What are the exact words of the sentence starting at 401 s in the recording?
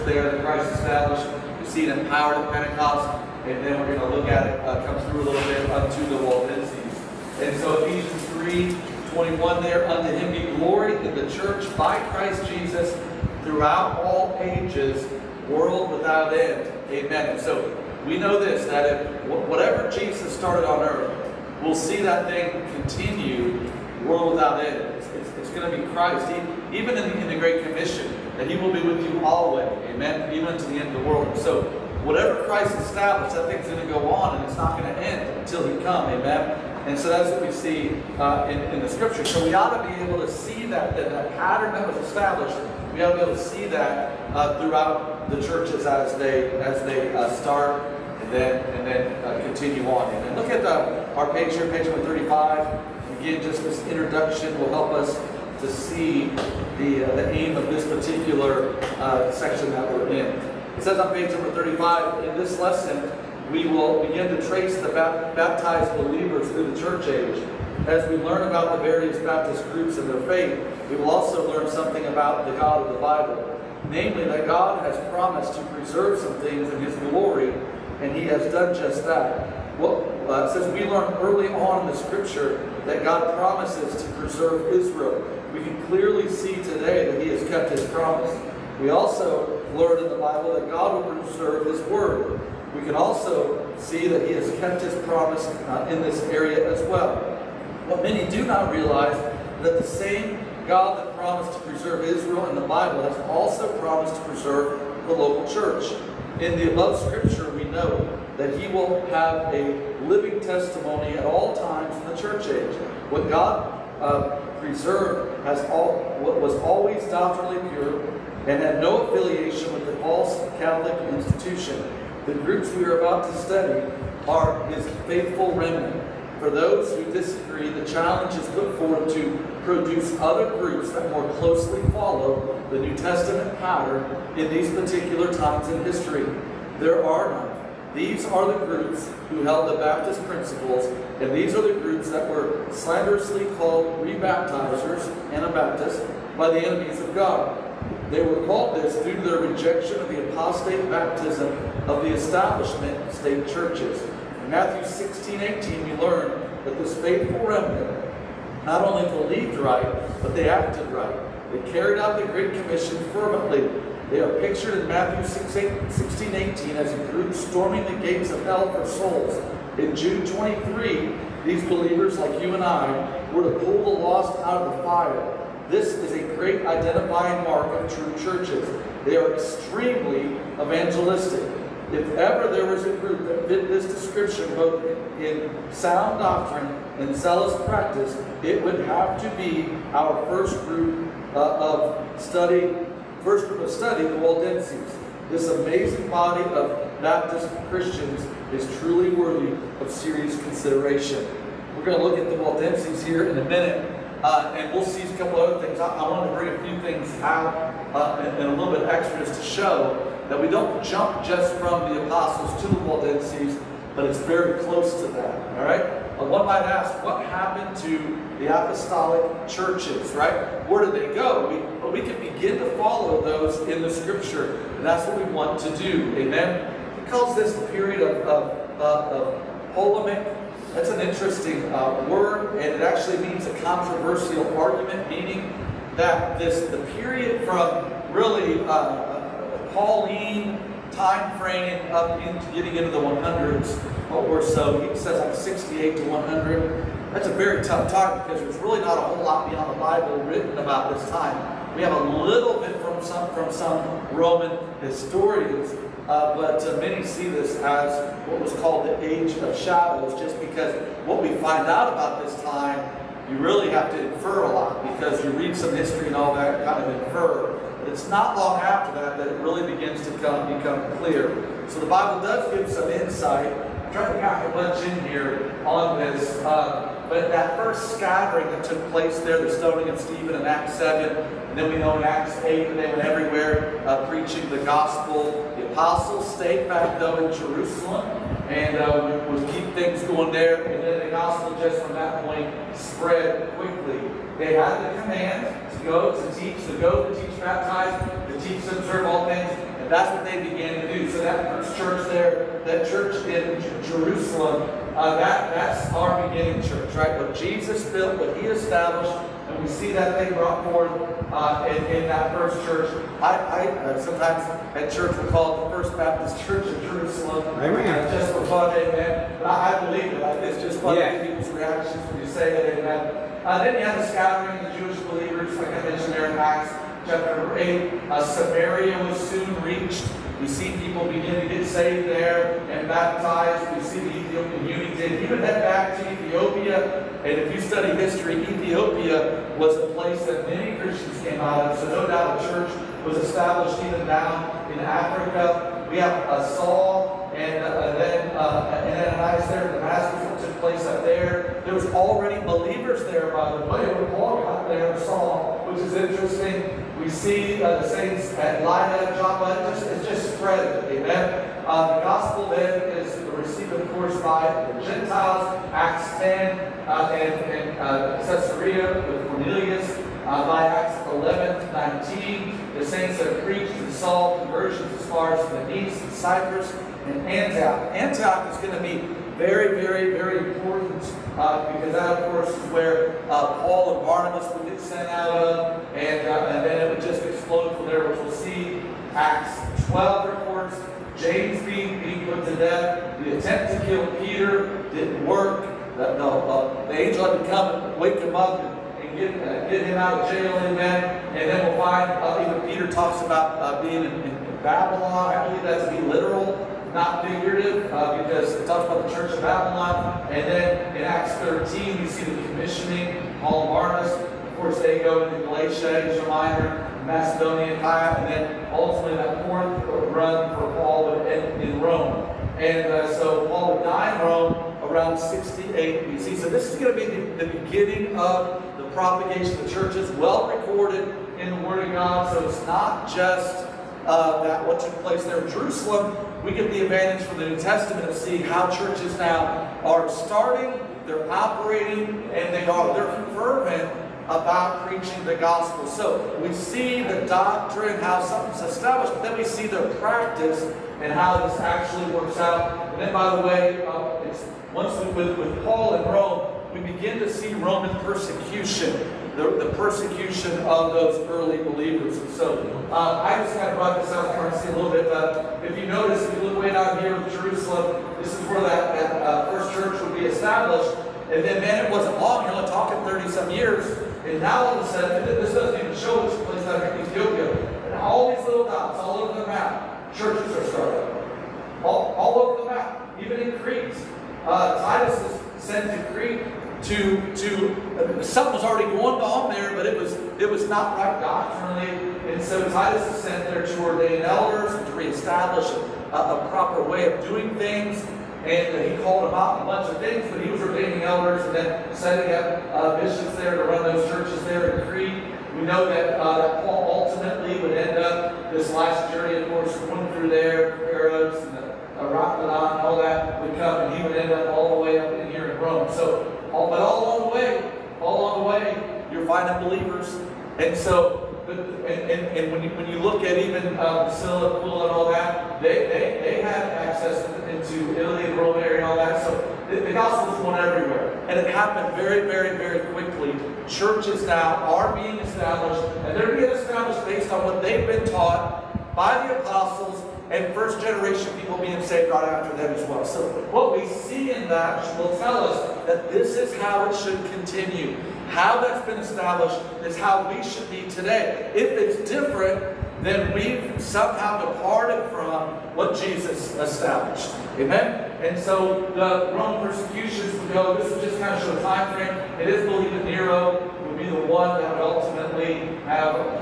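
And then we'll find, uh, even Peter talks about uh, being in, in Babylon.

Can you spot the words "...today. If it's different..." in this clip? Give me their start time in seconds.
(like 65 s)
550 s.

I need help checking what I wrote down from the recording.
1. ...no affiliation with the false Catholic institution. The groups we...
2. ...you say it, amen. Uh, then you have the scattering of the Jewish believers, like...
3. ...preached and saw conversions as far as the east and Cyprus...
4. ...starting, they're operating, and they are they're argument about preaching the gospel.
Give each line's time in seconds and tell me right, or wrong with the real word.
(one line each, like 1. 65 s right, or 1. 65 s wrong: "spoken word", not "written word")
1. 118 s right
2. 322 s right
3. 373 s right
4. 440 s wrong: "fervent", not "argument".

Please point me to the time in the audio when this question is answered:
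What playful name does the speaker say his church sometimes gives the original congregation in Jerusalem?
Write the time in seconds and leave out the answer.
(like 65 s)
315 s.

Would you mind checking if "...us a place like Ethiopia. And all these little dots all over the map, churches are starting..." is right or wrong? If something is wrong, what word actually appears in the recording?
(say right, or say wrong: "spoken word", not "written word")
right.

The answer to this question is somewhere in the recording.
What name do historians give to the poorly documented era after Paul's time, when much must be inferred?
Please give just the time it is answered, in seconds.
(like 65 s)
259 s.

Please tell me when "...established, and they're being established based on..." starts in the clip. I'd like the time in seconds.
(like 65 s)
535 s.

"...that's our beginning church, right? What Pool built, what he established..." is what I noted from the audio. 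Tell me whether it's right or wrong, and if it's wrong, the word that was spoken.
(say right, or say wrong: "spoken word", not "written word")
wrong: "Jesus", not "Pool".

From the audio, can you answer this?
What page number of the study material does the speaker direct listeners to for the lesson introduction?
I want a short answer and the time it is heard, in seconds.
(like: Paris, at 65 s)
135, at 51 s.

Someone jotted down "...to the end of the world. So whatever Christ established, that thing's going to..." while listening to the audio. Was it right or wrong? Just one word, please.
right.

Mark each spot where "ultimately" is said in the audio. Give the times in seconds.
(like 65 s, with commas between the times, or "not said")
418 s, 507 s, 564 s.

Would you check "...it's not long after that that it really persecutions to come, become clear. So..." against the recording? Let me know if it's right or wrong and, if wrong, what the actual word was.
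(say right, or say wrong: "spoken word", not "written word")
wrong: "begins", not "persecutions".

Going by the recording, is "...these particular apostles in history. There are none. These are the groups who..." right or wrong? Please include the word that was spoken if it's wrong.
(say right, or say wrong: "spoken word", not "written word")
wrong: "times", not "apostles".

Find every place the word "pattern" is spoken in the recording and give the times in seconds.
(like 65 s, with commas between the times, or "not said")
41 s, 133 s.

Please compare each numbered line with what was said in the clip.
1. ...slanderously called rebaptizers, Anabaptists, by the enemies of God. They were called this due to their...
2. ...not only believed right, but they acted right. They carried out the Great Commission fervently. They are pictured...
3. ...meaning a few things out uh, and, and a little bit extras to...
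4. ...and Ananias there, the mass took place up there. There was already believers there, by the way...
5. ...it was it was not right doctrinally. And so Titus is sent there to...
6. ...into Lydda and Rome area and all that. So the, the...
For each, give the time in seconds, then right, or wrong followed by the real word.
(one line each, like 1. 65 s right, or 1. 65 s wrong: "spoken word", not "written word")
1. 142 s right
2. 158 s right
3. 206 s wrong: "bring", not "meaning"
4. 348 s right
5. 489 s right
6. 527 s wrong: "Italy", not "Lydda".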